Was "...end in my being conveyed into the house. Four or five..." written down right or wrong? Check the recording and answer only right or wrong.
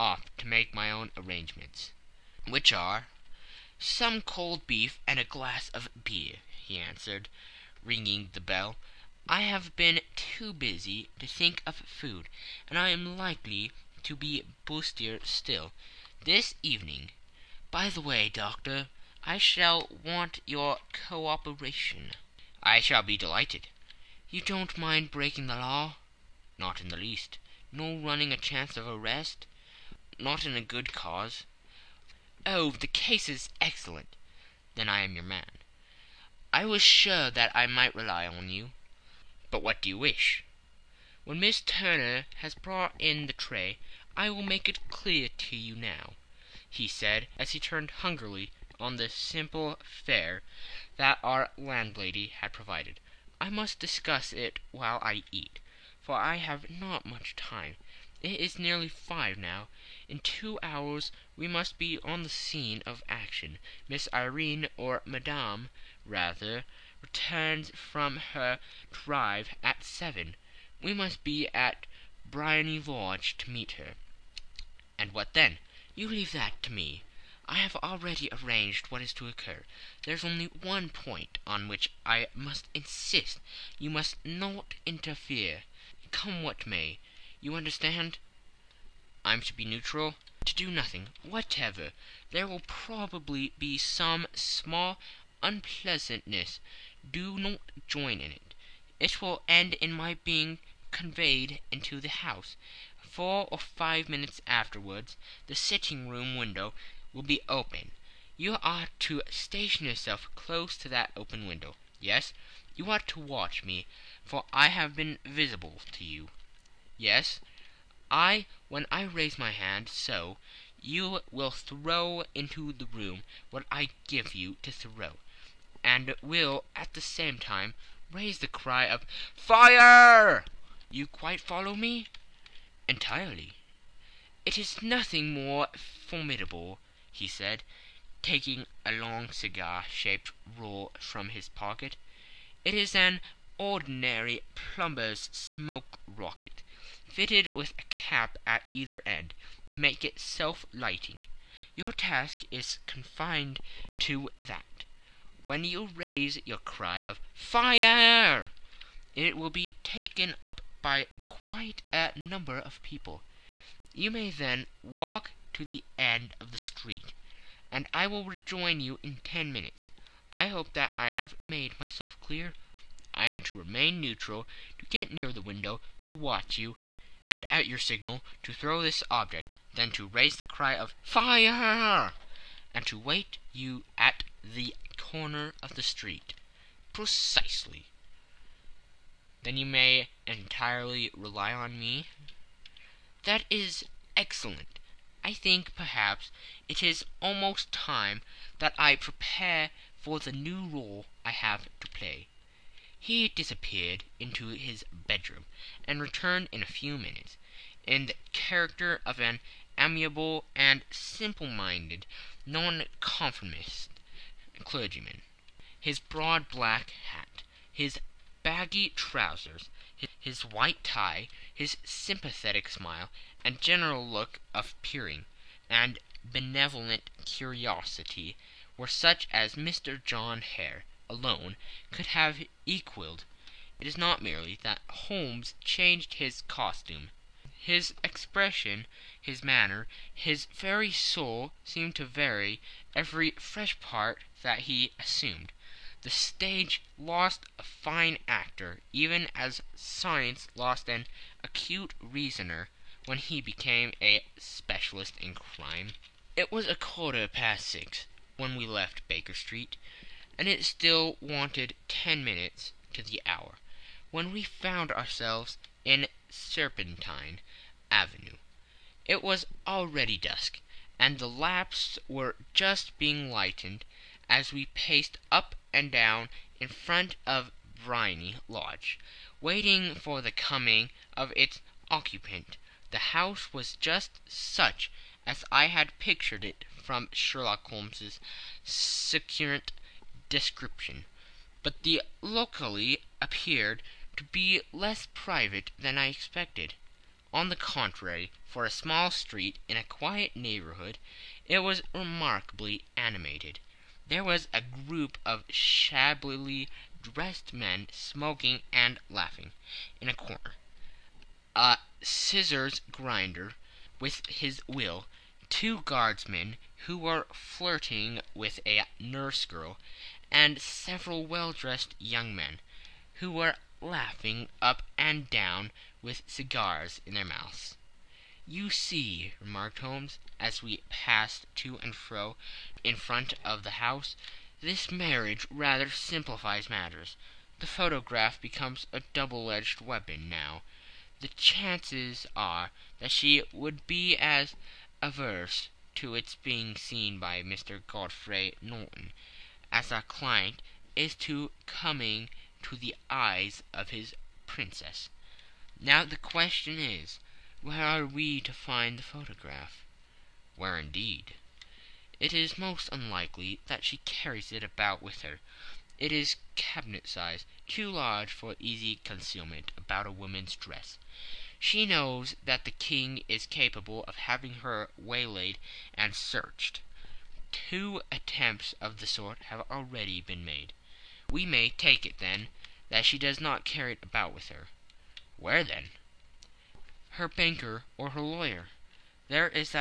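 right.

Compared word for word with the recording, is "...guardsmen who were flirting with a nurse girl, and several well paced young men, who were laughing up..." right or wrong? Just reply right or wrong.
wrong.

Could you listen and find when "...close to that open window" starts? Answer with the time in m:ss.
1:50.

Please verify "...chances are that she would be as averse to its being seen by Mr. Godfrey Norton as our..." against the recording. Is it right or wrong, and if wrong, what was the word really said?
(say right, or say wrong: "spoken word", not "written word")
right.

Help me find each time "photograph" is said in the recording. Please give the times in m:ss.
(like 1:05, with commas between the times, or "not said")
5:37, 5:59.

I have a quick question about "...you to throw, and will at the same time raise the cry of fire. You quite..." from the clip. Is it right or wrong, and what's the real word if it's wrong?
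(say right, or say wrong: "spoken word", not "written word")
right.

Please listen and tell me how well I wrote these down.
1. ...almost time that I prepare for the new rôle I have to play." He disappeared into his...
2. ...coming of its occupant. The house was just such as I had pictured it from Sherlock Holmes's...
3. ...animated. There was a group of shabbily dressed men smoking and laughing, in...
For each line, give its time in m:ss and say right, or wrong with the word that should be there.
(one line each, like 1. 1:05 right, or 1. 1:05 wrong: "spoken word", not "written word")
1. 3:17 right
2. 4:40 right
3. 5:02 right.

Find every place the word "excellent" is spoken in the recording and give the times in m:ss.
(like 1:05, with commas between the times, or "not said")
0:33, 3:14.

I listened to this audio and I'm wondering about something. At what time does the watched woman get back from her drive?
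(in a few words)
7.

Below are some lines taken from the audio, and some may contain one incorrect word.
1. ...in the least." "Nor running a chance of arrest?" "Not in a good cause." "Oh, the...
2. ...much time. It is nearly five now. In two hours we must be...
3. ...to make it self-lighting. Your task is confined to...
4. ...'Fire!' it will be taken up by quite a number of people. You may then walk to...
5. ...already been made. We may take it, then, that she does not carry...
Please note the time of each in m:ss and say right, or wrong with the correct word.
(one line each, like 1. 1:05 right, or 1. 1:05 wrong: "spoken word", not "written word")
1. 0:26 right
2. 0:57 right
3. 2:29 right
4. 2:37 right
5. 6:19 right.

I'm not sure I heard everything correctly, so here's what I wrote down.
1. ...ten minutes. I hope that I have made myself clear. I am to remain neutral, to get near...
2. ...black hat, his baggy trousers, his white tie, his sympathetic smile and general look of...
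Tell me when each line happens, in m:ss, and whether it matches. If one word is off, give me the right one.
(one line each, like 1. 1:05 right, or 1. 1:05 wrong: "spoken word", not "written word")
1. 2:49 right
2. 3:36 right.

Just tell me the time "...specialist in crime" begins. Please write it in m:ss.
4:14.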